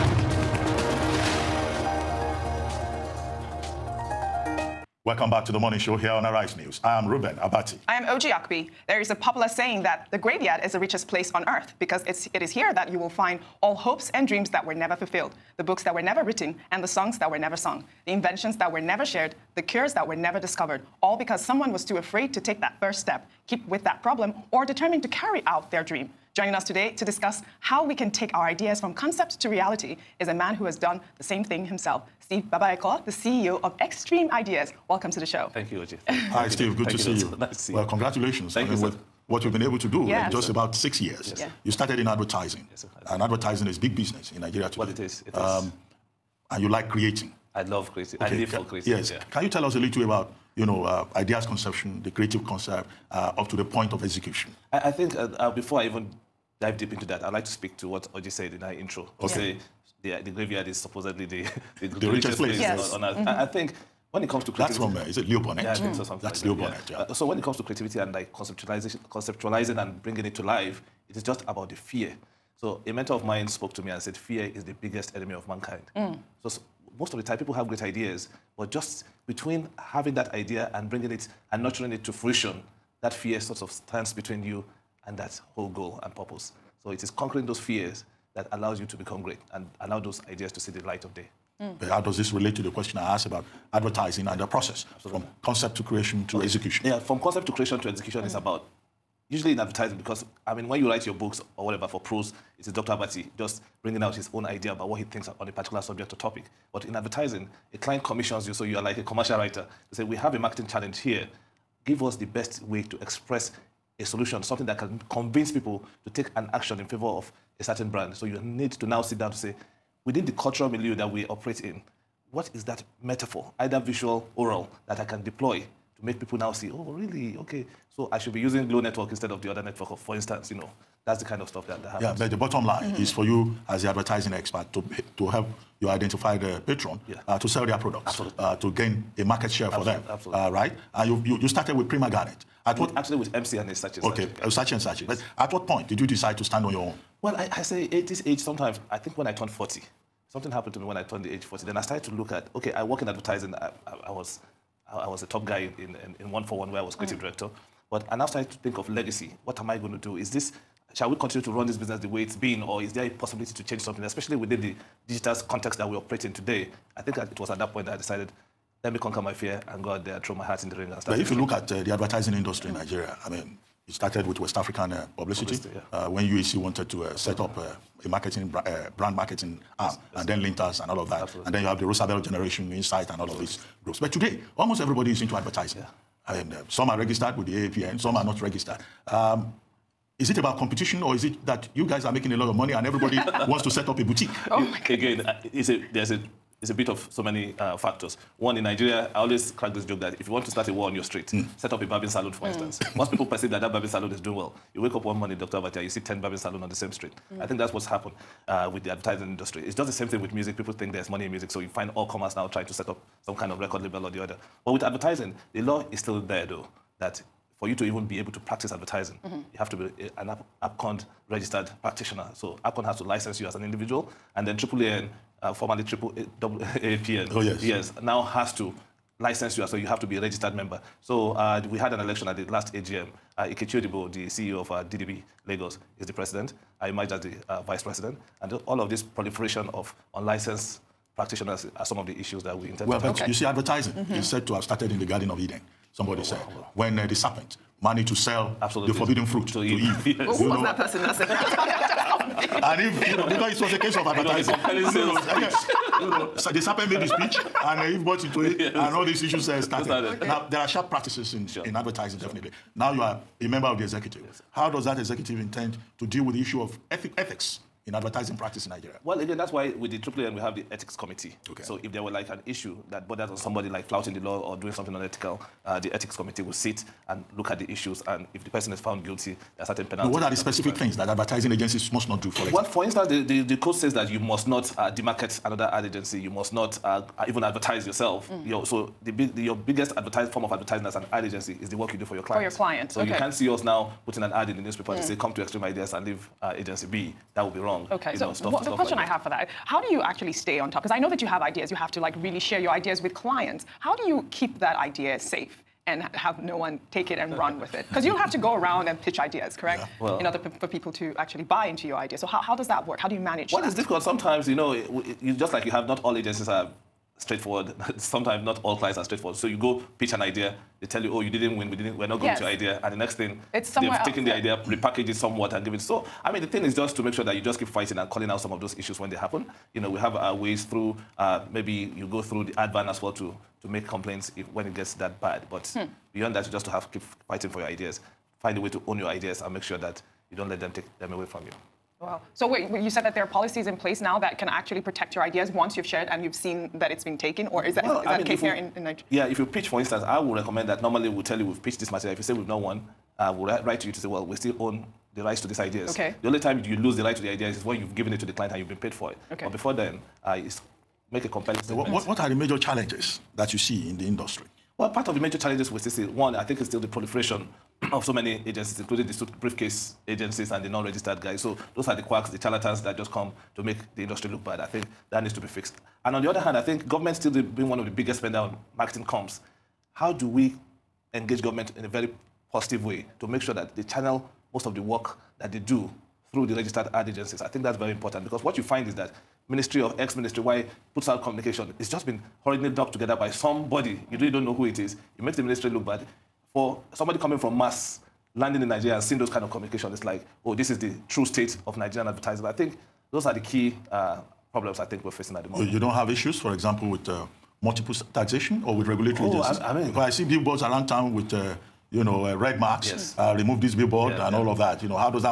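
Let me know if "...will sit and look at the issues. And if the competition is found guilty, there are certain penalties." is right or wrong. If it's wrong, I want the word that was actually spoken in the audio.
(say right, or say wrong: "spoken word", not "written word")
wrong: "person", not "competition".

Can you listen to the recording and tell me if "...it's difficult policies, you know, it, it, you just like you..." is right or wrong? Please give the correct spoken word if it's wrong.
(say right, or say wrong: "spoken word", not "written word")
wrong: "sometimes", not "policies".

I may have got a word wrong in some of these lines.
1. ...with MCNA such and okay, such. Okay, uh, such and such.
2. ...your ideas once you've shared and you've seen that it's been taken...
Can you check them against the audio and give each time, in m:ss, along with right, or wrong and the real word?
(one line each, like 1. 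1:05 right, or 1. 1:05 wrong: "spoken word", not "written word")
1. 2:23 right
2. 5:45 right.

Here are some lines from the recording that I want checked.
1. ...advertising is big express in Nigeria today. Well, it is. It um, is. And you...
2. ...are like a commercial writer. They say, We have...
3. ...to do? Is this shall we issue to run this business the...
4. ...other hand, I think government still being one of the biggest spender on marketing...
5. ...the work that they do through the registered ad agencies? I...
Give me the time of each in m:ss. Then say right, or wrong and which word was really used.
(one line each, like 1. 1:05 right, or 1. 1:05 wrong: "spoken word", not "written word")
1. 0:43 wrong: "business", not "express"
2. 1:48 right
3. 2:39 wrong: "continue", not "issue"
4. 6:16 right
5. 6:24 right.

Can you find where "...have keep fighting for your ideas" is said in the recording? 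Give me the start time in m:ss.
5:36.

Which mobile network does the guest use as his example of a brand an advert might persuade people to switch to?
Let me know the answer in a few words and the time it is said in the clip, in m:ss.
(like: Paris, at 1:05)
Glo, at 2:08.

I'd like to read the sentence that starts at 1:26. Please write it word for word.
So it is conquering those fears that allows you to become great and allow those ideas to see the light of day.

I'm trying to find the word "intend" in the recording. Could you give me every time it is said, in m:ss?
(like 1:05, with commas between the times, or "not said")
4:02, 4:25.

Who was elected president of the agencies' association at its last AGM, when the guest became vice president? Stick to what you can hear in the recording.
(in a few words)
Ikechi Odibo.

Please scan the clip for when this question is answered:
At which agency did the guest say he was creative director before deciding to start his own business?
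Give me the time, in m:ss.
2:36.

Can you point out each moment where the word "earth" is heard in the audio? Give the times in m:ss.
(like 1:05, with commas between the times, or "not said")
0:11, 1:03.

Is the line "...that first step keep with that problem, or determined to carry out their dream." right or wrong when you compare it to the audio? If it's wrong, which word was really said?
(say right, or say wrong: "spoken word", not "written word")
right.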